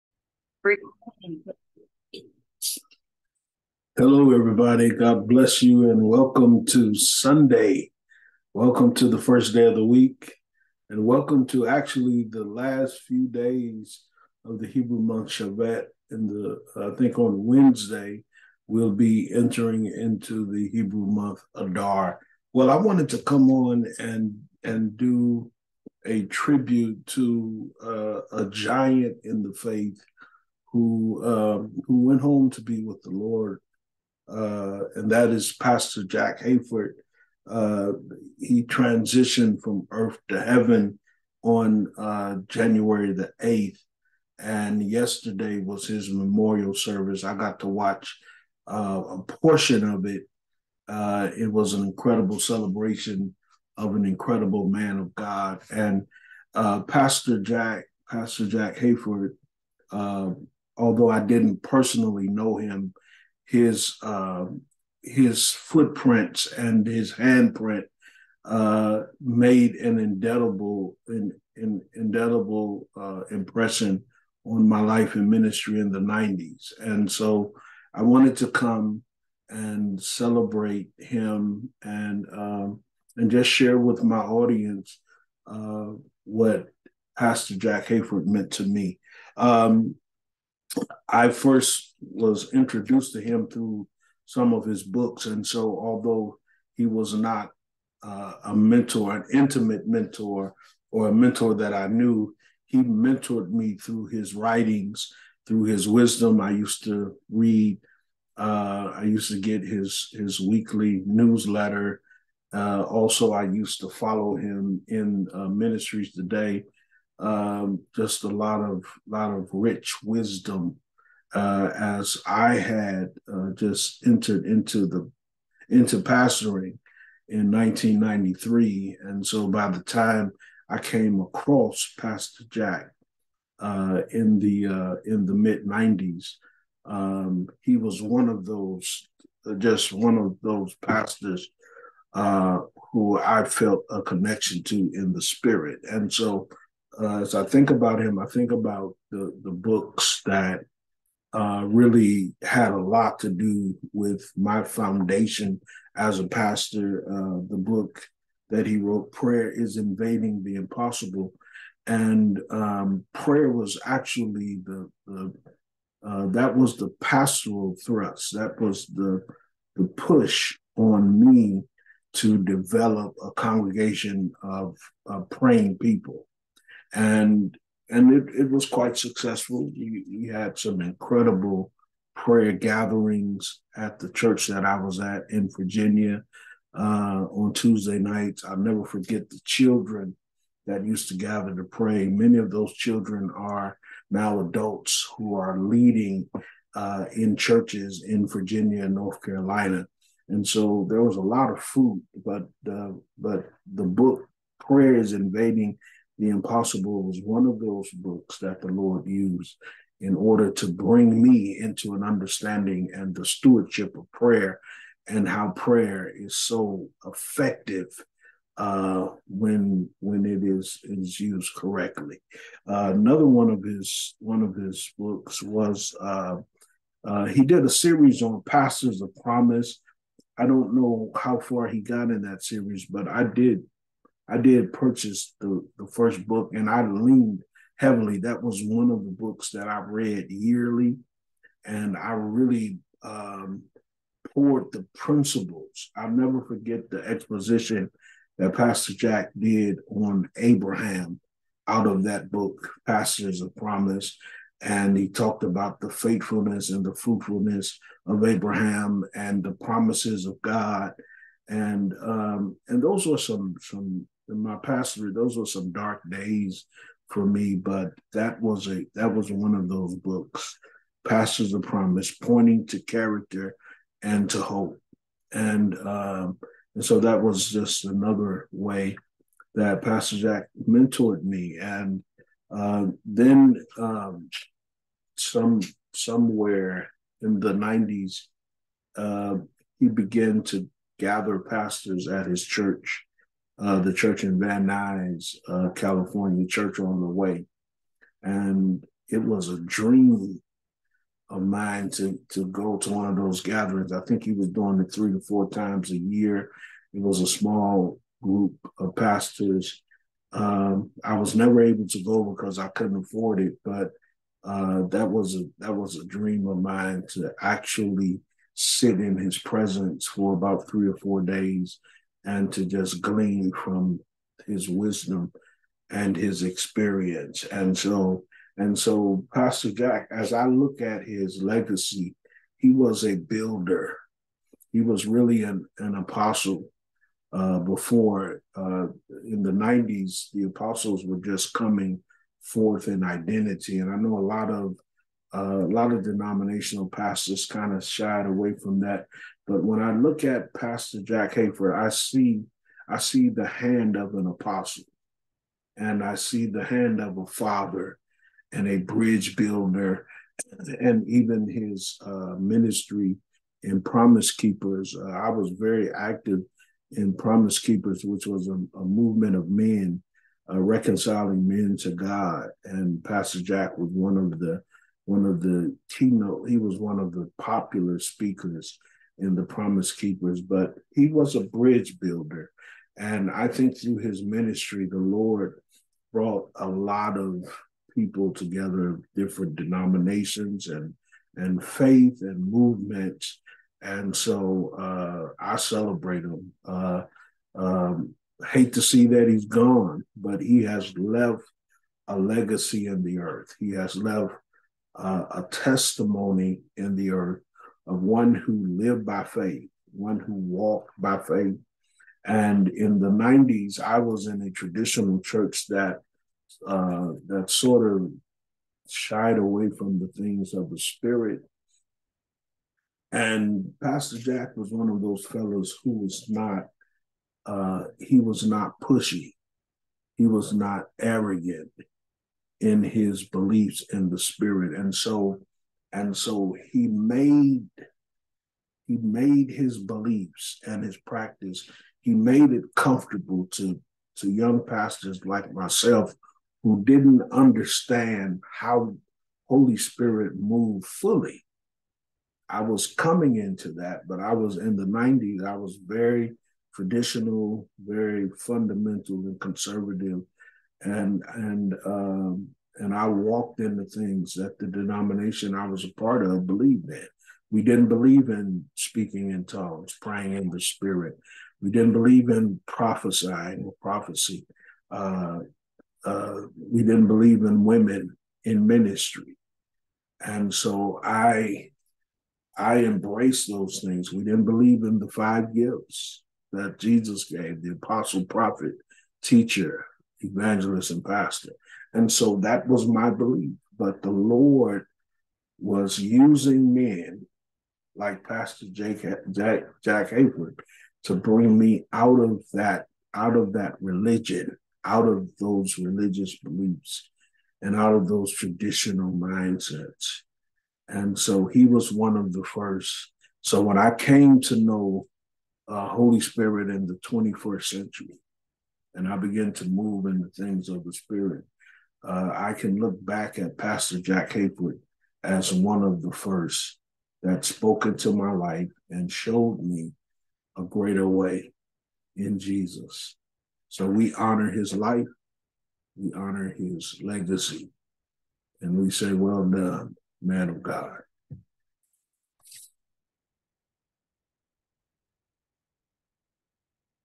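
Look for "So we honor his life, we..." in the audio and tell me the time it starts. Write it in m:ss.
8:53.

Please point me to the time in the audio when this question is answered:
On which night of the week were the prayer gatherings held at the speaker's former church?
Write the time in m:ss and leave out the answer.
3:07.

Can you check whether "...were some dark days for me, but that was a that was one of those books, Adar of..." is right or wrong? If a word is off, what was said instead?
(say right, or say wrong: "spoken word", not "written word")
wrong: "Pastors", not "Adar".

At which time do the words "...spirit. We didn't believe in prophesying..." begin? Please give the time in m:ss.
7:50.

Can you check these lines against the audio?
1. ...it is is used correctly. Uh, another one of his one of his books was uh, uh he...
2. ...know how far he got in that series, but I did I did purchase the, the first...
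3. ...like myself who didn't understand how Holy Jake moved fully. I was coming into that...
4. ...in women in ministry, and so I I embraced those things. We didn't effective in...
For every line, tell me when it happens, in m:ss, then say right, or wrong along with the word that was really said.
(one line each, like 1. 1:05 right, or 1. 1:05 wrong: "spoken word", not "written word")
1. 3:40 right
2. 3:50 right
3. 7:25 wrong: "Spirit", not "Jake"
4. 7:57 wrong: "believe", not "effective".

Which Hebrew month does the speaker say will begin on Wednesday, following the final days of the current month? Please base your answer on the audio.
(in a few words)
Adar.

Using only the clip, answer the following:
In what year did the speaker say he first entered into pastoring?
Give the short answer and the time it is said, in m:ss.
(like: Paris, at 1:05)
1993, at 2:07.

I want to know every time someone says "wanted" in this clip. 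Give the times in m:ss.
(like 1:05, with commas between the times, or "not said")
0:22, 1:18.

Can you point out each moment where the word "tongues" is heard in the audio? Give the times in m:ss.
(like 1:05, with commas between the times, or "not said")
7:49.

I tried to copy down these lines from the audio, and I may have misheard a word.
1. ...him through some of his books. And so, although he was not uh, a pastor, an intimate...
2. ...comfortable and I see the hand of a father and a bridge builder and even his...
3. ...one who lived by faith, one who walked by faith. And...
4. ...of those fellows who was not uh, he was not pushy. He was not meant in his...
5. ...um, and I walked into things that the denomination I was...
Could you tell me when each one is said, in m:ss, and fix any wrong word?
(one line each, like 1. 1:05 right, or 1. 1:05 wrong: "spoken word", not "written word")
1. 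1:33 wrong: "mentor", not "pastor"
2. 5:54 wrong: "apostle", not "comfortable"
3. 6:48 right
4. 7:04 wrong: "arrogant", not "meant"
5. 7:41 right.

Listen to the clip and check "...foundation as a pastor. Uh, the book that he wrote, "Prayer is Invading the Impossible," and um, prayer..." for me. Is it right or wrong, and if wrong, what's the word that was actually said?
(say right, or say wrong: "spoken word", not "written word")
right.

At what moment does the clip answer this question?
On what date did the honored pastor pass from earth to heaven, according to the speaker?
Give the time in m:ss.
0:42.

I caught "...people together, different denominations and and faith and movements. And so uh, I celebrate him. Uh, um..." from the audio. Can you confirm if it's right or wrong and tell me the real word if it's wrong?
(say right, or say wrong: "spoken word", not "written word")
right.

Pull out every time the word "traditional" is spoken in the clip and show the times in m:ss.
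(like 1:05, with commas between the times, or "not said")
6:54, 7:36, 8:28.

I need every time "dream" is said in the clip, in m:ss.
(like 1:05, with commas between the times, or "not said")
4:59, 5:16.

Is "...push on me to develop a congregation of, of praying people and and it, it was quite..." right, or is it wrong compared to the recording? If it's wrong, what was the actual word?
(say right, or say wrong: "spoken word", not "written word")
right.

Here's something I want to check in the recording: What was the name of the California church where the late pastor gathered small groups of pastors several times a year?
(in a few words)
Church on the Way.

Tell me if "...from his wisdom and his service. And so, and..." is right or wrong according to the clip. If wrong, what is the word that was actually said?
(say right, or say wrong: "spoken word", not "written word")
wrong: "experience", not "service".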